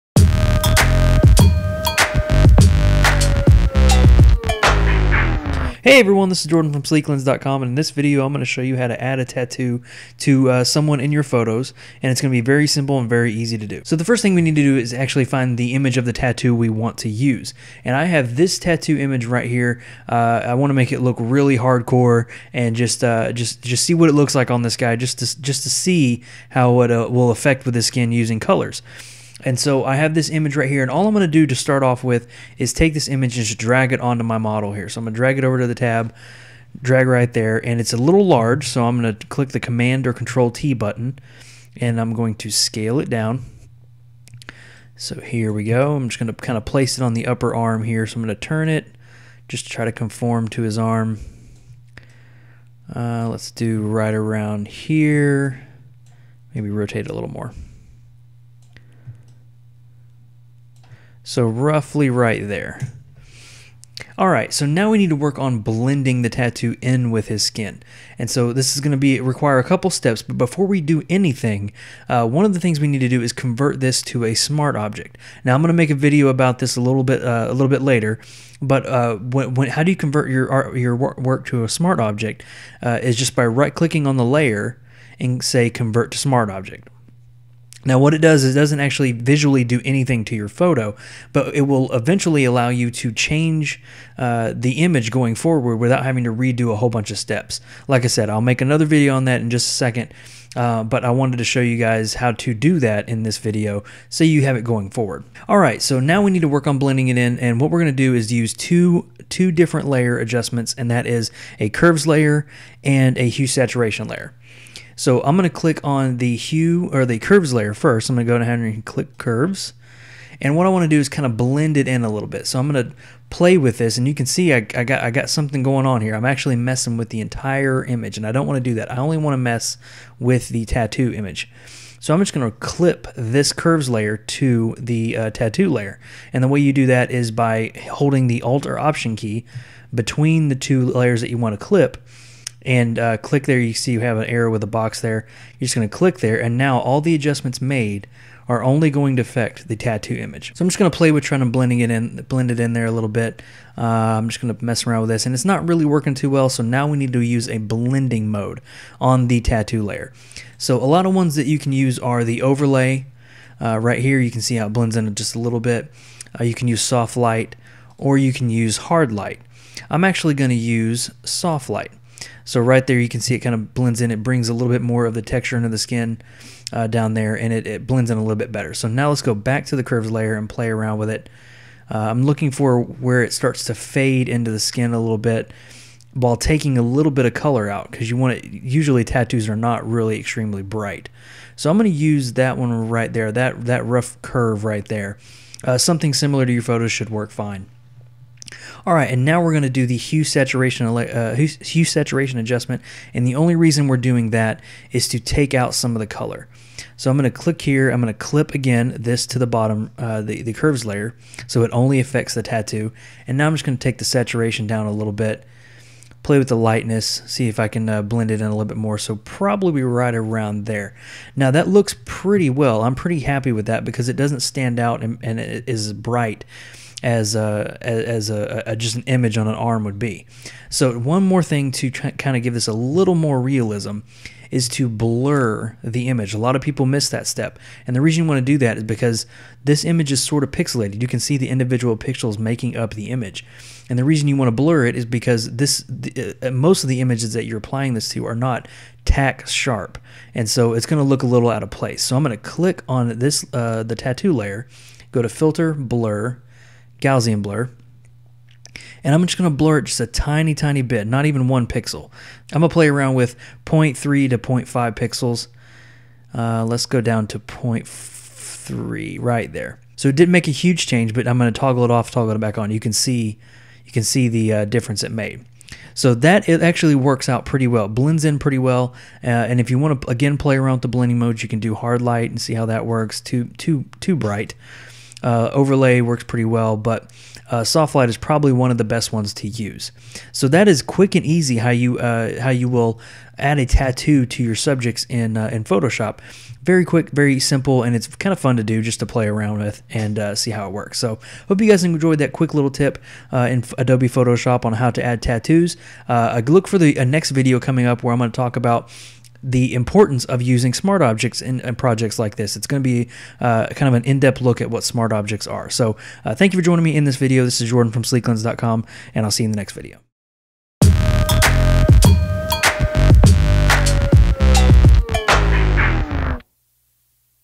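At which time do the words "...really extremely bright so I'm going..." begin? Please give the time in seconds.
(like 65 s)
189 s.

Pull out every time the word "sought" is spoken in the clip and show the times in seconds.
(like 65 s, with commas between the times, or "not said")
not said.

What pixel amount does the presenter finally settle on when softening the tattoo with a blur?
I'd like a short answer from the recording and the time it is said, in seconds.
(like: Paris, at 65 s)
0.3 pixels, at 266 s.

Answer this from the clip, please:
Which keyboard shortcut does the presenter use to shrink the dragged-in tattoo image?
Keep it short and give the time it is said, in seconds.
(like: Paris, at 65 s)
Command or Control T, at 39 s.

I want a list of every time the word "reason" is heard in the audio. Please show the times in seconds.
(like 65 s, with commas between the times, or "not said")
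203 s, 238 s, 244 s.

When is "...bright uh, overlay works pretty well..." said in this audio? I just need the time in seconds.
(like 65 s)
284 s.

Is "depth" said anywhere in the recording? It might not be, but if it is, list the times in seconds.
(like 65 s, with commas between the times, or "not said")
314 s.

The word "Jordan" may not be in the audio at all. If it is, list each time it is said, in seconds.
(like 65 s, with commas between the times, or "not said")
6 s, 317 s.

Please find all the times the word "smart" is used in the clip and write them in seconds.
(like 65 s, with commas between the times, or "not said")
74 s, 81 s, 86 s, 310 s, 314 s.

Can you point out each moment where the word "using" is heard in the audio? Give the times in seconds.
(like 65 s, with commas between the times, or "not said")
28 s, 310 s.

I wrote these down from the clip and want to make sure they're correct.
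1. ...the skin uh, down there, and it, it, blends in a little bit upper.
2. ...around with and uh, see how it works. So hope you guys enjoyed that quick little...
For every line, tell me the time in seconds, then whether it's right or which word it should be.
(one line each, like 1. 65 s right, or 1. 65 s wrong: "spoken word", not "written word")
1. 175 s wrong: "better", not "upper"
2. 299 s right.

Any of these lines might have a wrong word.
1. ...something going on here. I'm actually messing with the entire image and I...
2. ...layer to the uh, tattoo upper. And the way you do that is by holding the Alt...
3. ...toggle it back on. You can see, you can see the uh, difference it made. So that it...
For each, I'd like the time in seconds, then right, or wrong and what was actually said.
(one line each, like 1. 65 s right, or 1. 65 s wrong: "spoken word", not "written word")
1. 125 s right
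2. 133 s wrong: "layer", not "upper"
3. 272 s right.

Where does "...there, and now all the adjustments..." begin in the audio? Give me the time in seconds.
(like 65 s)
146 s.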